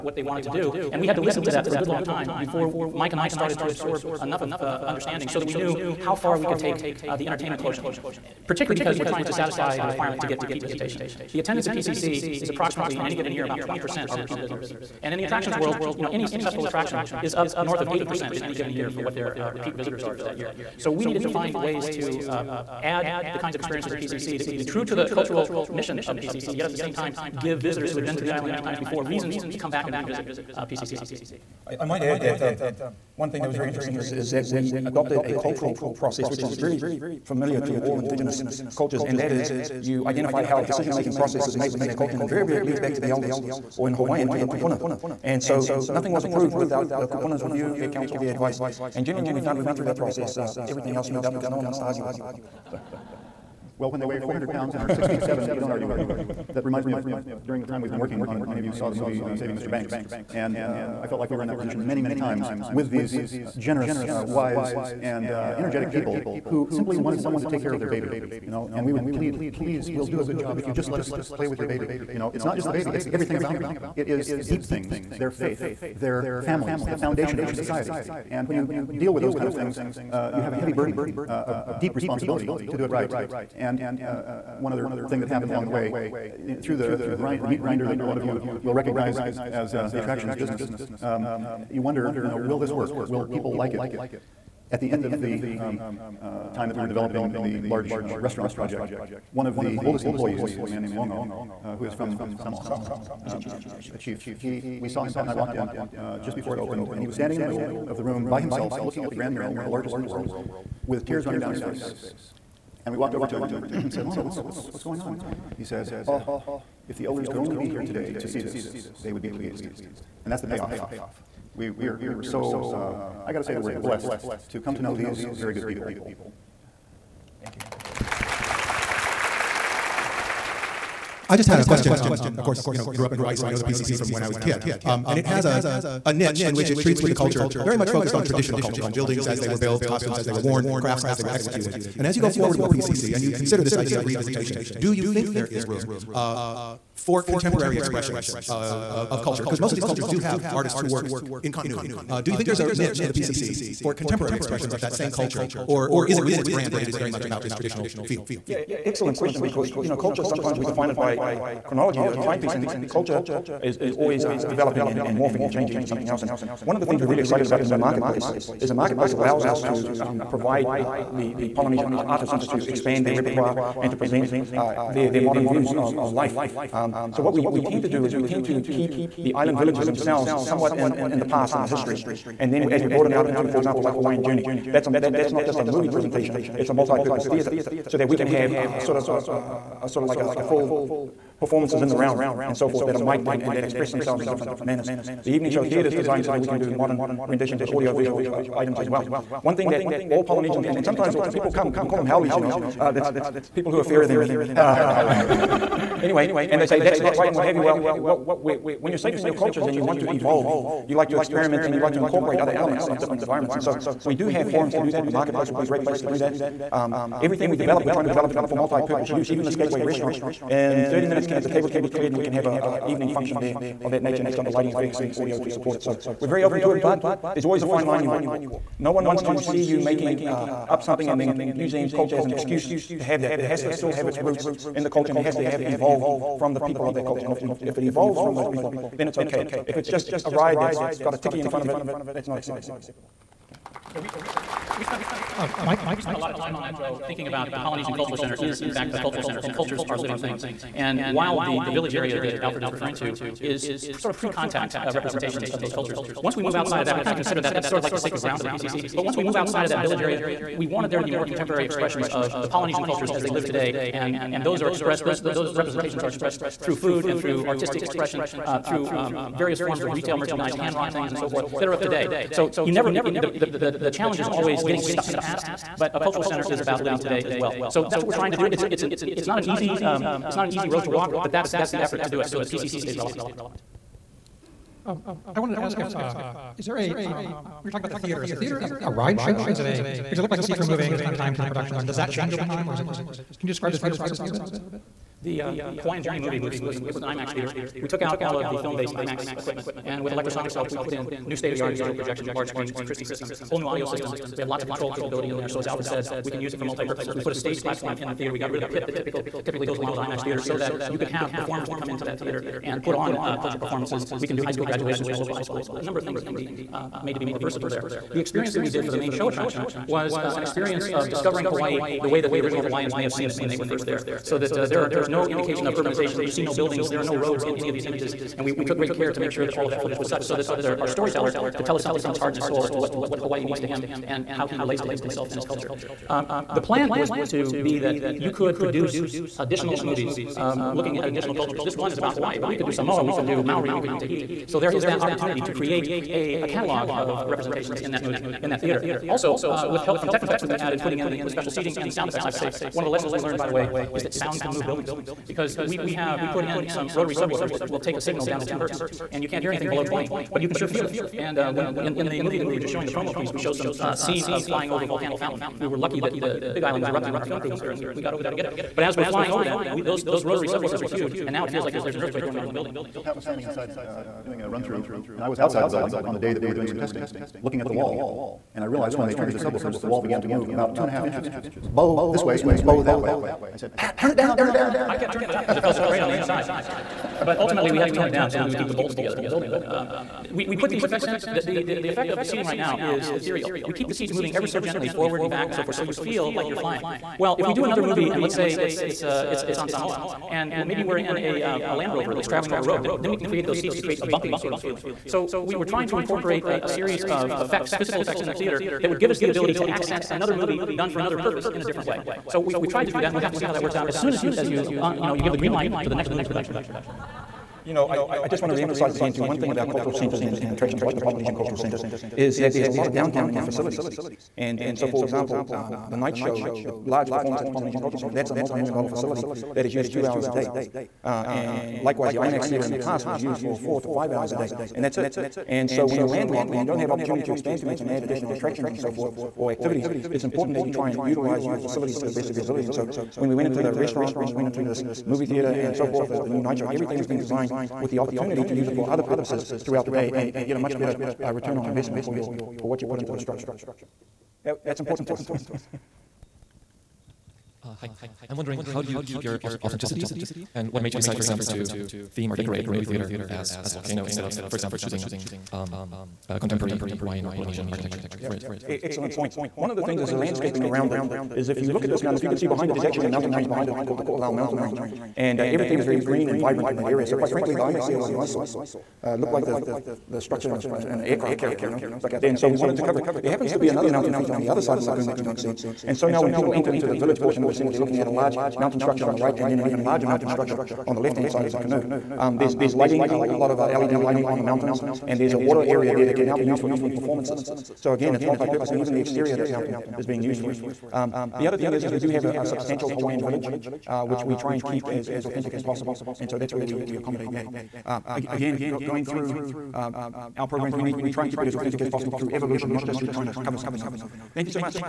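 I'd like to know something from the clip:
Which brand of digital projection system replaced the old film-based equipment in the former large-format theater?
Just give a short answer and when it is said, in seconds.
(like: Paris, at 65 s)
Christie, at 302 s.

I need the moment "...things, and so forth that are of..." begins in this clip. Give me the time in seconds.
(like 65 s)
270 s.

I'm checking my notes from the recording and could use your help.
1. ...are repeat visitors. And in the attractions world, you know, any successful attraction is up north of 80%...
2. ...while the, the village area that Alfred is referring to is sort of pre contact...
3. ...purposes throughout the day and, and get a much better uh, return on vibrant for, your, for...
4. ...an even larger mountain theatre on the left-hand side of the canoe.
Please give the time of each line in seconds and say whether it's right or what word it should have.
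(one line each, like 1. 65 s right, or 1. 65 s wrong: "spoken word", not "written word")
1. 14 s right
2. 251 s right
3. 449 s wrong: "investment", not "vibrant"
4. 489 s wrong: "structure", not "theatre".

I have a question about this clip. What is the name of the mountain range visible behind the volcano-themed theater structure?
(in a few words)
Ko'olau Mountain Range.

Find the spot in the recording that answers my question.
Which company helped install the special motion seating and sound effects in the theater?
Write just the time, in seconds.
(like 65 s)
350 s.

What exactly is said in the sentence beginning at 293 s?
Can you describe the theater process a little bit?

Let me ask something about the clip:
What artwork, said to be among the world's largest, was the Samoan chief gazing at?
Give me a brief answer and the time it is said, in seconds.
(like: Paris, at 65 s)
Grand Mural, at 109 s.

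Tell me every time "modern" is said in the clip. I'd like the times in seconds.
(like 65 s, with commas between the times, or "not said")
175 s, 196 s.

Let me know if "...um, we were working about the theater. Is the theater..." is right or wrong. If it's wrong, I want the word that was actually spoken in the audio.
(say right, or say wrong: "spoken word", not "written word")
wrong: "talking", not "working".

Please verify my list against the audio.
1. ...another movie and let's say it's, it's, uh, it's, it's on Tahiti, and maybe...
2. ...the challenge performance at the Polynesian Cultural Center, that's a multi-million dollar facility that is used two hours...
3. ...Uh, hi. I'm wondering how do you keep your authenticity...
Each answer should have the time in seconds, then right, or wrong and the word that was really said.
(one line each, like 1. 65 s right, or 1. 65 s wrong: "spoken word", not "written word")
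1. 397 s wrong: "Samoa", not "Tahiti"
2. 426 s wrong: "large", not "challenge"
3. 457 s right.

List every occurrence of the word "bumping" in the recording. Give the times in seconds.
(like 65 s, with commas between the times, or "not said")
404 s.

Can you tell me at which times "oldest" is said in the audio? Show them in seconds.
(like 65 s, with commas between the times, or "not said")
99 s.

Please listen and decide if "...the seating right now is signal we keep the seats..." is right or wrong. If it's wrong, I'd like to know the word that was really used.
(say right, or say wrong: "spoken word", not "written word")
wrong: "ethereal", not "signal".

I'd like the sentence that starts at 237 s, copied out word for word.
And if, we, if it evolves from those people, then it's okay.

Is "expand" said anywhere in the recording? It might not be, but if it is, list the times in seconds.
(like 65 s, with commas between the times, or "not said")
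172 s, 437 s.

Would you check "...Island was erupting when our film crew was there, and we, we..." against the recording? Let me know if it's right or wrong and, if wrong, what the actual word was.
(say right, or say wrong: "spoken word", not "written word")
right.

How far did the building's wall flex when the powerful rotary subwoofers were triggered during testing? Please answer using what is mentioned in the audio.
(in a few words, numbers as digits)
2.5 inches.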